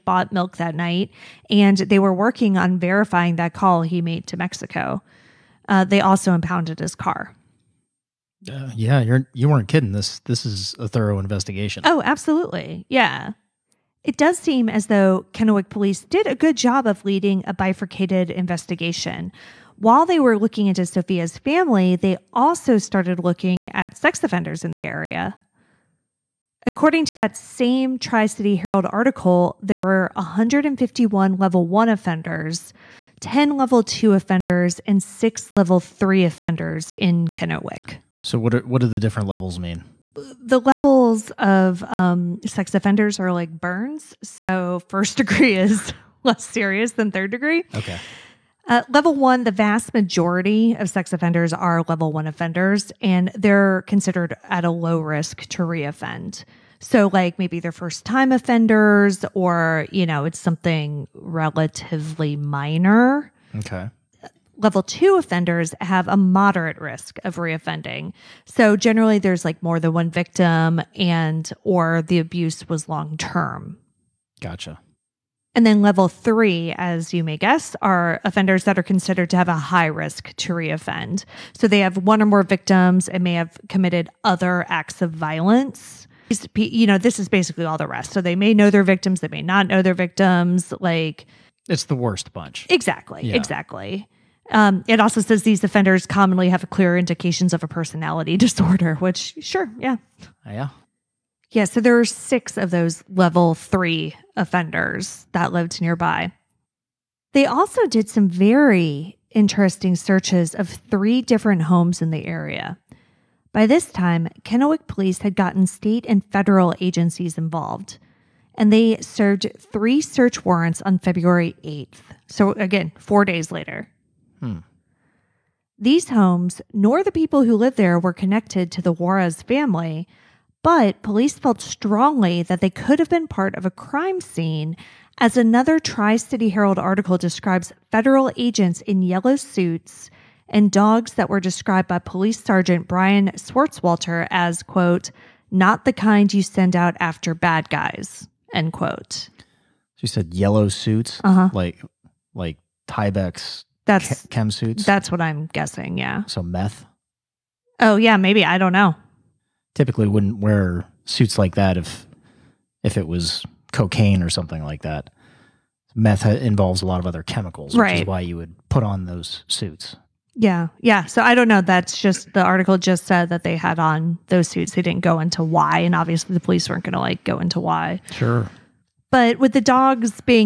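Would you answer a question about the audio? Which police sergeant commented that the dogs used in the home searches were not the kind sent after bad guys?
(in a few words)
Brian Swartzwalter.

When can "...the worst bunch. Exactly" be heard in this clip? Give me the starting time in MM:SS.
01:31.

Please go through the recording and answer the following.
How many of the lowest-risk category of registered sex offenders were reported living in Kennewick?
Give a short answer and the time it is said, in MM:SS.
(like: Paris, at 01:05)
151, at 00:30.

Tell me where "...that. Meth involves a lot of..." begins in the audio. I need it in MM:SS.
02:44.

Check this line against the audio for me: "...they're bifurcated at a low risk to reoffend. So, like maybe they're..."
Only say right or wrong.
wrong.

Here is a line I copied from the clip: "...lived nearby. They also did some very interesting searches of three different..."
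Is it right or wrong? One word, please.
right.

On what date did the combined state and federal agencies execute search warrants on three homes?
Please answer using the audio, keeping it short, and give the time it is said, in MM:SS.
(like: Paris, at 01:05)
February 8th, at 02:00.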